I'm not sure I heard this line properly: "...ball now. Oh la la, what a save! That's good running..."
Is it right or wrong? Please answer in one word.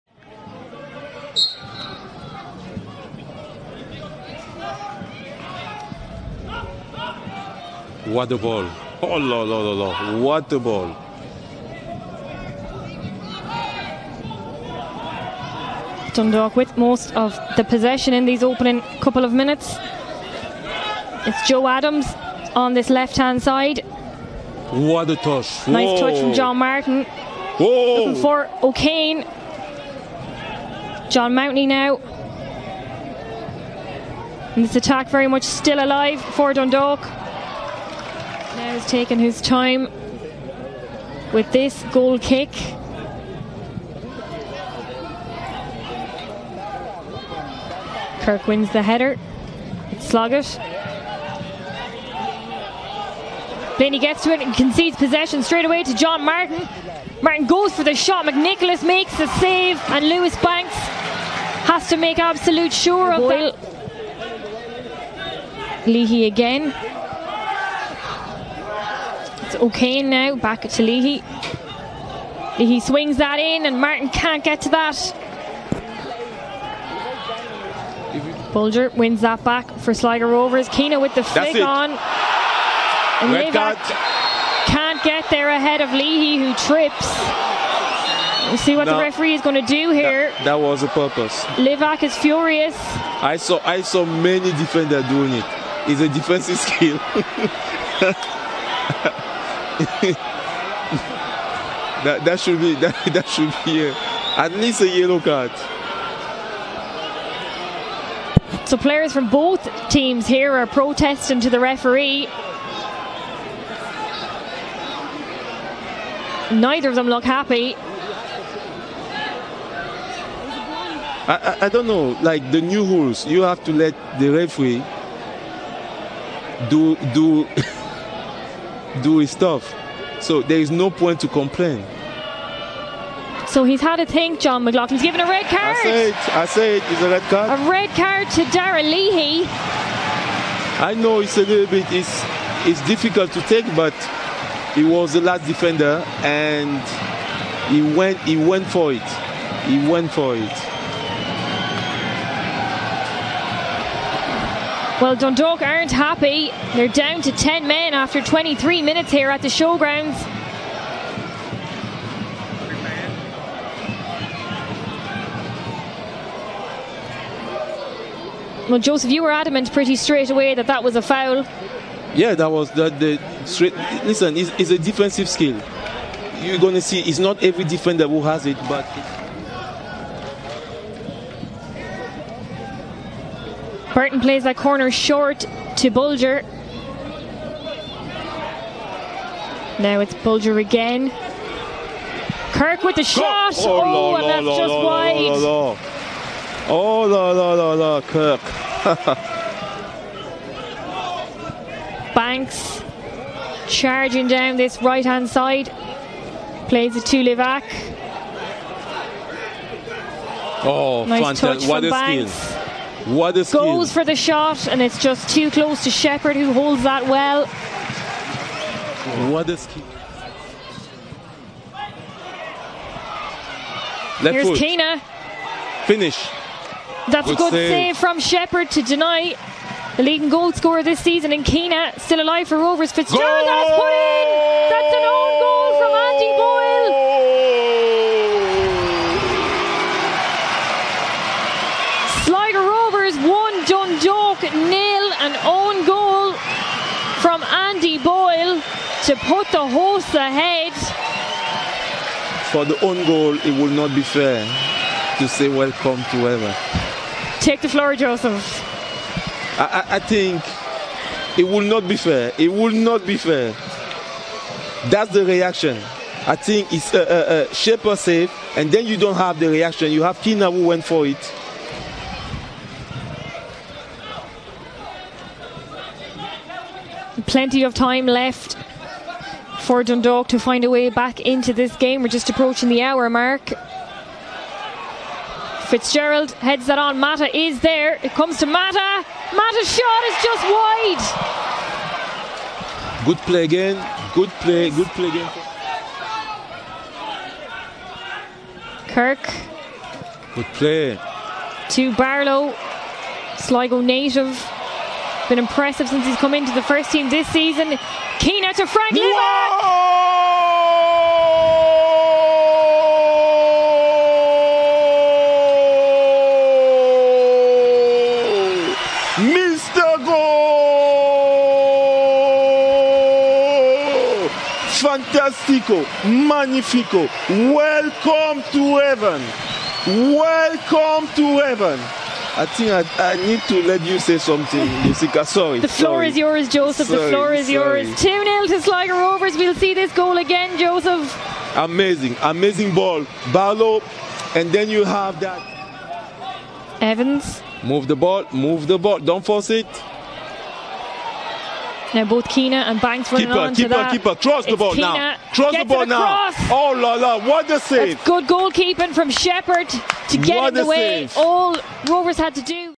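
wrong.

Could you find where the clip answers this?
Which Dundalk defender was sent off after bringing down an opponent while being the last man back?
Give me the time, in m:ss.
2:18.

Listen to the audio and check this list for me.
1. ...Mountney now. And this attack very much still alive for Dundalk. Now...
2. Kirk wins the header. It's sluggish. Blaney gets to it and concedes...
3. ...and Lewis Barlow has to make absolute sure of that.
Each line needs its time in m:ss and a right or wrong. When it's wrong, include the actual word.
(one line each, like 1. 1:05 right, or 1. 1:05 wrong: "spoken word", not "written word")
1. 0:31 right
2. 0:48 right
3. 0:59 wrong: "Banks", not "Barlow".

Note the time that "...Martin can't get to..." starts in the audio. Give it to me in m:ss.
1:13.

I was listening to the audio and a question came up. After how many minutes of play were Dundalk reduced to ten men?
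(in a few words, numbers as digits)
23.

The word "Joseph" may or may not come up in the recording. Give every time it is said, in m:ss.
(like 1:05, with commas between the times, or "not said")
2:48, 4:17, 5:36, 5:40.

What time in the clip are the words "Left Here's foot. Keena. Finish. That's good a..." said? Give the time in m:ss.
3:44.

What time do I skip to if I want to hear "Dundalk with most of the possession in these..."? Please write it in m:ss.
0:16.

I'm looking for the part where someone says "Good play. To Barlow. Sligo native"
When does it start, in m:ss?
5:00.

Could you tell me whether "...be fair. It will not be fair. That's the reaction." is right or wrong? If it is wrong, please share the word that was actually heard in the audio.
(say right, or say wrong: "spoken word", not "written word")
right.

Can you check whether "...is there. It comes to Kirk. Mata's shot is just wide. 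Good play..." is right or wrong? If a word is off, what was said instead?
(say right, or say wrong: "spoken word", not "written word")
wrong: "Mata", not "Kirk".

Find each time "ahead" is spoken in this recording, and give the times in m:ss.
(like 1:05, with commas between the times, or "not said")
1:25, 4:10.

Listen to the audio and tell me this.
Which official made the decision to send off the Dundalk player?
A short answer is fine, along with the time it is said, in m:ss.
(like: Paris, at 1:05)
John McLaughlin, at 2:14.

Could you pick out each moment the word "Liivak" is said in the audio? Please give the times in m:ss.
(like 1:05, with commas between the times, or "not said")
1:31, 3:27, 5:08.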